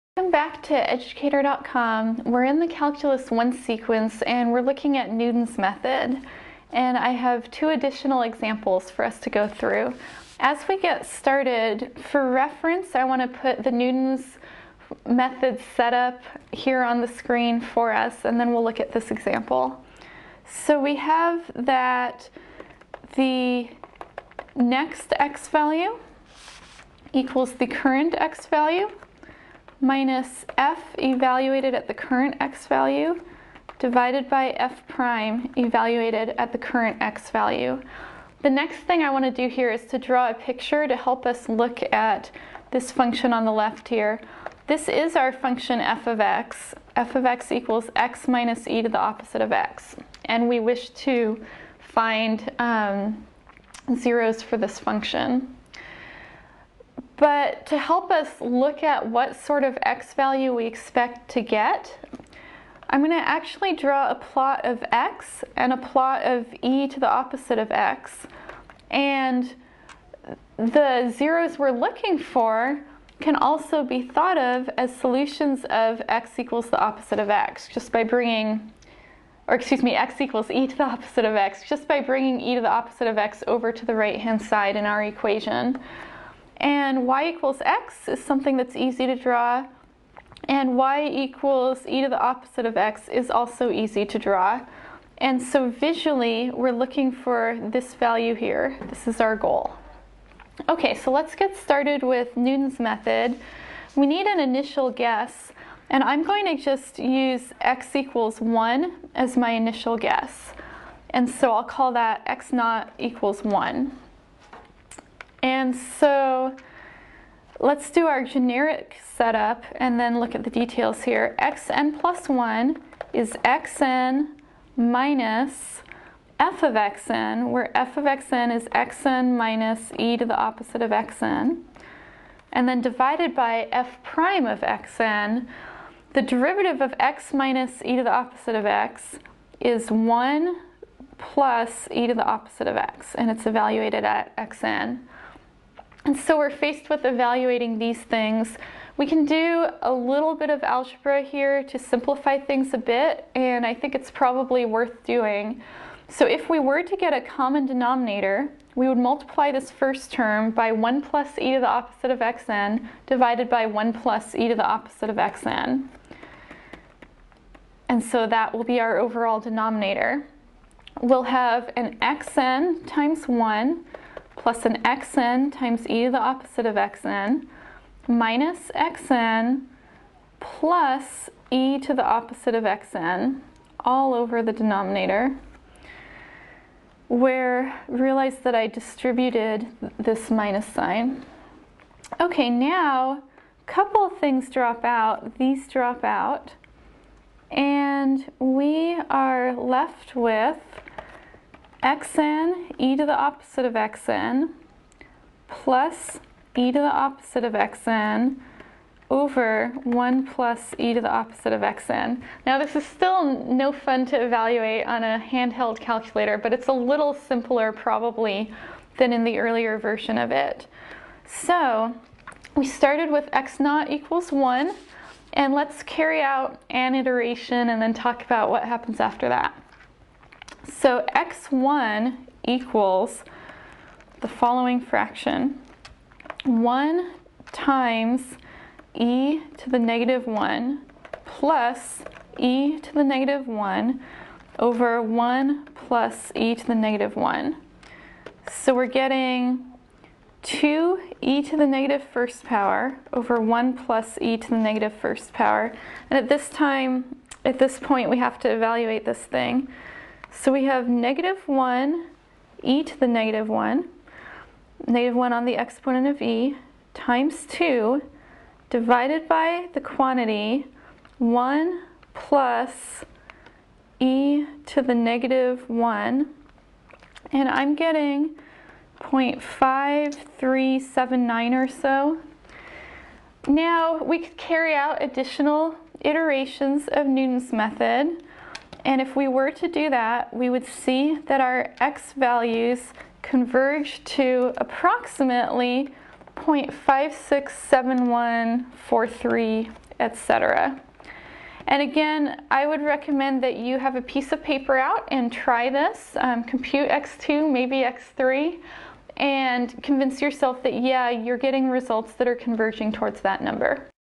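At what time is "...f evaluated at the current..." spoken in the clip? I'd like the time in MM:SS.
00:30.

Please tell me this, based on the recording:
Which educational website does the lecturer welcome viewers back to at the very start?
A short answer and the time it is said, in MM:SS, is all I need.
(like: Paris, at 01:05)
educator.com, at 00:00.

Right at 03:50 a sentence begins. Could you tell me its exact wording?
So x1 equals the following fraction.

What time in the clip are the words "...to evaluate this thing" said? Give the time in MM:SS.
04:18.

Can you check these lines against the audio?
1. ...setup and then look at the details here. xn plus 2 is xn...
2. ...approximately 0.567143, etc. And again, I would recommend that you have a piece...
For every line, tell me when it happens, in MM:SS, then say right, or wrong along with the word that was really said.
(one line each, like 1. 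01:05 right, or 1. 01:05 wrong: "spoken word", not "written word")
1. 01:59 wrong: "1", not "2"
2. 04:54 right.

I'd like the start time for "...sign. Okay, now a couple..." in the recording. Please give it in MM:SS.
03:10.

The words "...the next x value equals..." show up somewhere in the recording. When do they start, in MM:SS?
00:23.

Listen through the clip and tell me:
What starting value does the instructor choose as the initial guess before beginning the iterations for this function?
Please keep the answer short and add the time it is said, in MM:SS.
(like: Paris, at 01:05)
x = 1, at 01:47.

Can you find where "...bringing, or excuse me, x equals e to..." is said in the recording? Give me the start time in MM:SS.
01:18.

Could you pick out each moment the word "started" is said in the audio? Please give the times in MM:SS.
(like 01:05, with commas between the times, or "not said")
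00:11, 01:41, 03:42.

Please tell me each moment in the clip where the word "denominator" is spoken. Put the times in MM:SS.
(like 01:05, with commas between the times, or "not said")
02:37, 02:49, 03:04.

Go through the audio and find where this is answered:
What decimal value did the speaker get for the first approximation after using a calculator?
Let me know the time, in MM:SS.
04:39.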